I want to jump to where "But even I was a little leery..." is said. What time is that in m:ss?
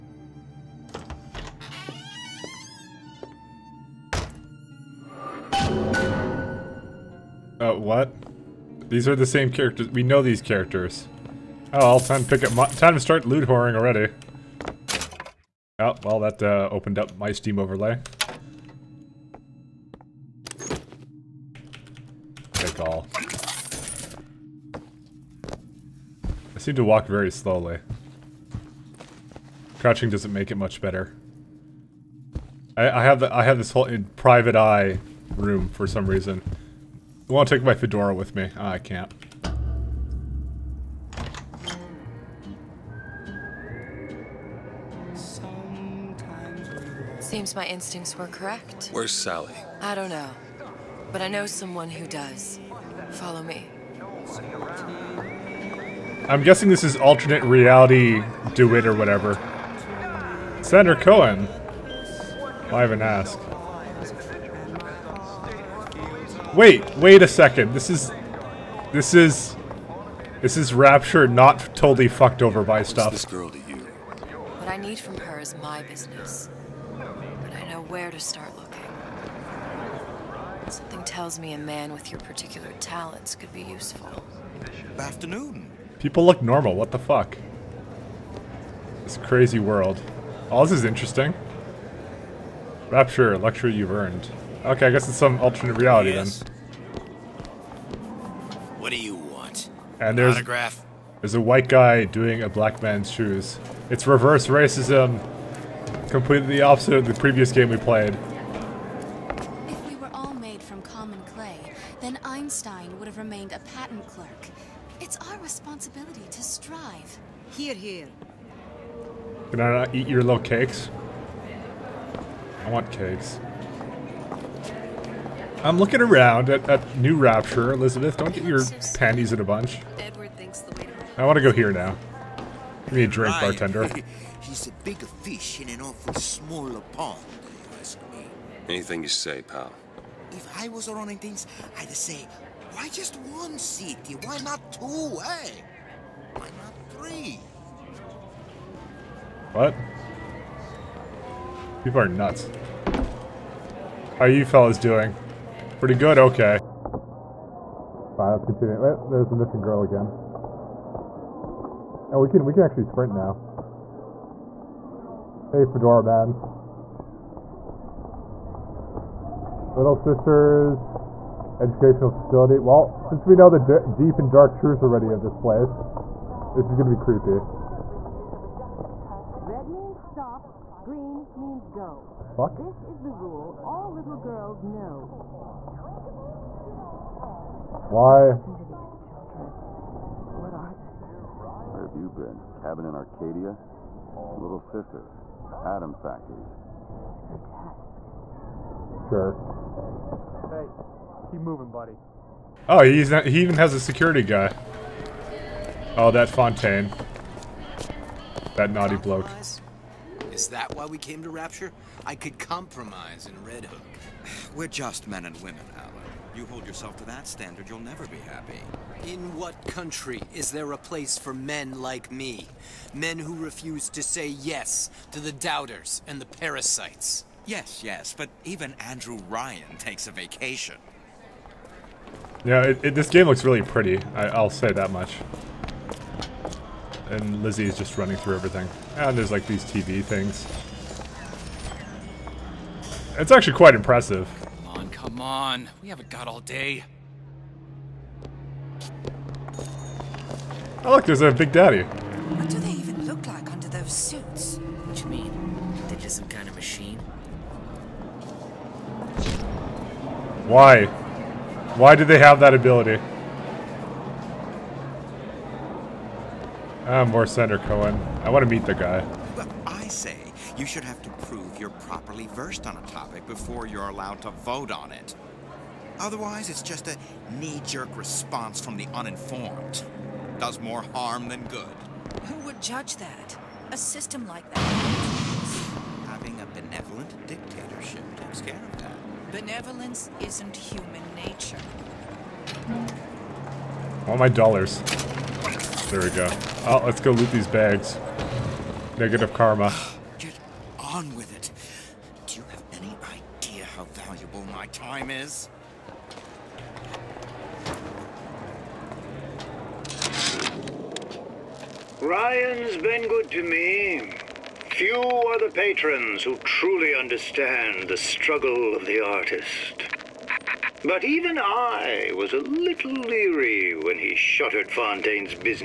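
5:20.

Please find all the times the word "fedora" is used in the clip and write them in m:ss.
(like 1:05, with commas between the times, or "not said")
0:37, 2:45.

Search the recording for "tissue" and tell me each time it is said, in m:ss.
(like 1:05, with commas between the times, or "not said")
not said.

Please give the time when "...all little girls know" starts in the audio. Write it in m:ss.
3:03.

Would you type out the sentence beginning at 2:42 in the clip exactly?
Oh, we can we can actually sprint now.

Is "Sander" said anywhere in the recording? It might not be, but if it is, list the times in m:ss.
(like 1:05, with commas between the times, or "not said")
1:00, 4:27.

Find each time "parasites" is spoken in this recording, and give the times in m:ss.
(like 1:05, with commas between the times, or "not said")
3:46.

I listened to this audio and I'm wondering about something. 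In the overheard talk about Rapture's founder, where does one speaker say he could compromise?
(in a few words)
Red Hook.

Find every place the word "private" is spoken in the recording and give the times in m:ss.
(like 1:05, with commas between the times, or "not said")
0:34.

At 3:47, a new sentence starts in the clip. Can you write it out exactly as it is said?
Yes, yes, but even Andrew Ryan takes a vacation.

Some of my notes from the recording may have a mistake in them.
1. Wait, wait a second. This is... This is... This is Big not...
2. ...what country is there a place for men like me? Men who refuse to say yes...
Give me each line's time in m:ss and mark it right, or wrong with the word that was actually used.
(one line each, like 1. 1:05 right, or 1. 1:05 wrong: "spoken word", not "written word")
1. 1:06 wrong: "Rapture", not "Big"
2. 3:39 right.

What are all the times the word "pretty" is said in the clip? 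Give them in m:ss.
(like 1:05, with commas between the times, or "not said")
2:35, 3:53.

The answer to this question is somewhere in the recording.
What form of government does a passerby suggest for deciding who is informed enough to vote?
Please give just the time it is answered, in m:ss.
4:46.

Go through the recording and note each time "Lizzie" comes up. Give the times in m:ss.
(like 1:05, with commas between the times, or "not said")
3:57.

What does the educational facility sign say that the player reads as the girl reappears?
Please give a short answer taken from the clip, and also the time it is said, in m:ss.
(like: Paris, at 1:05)
Little Sisters Educational Facility, at 2:49.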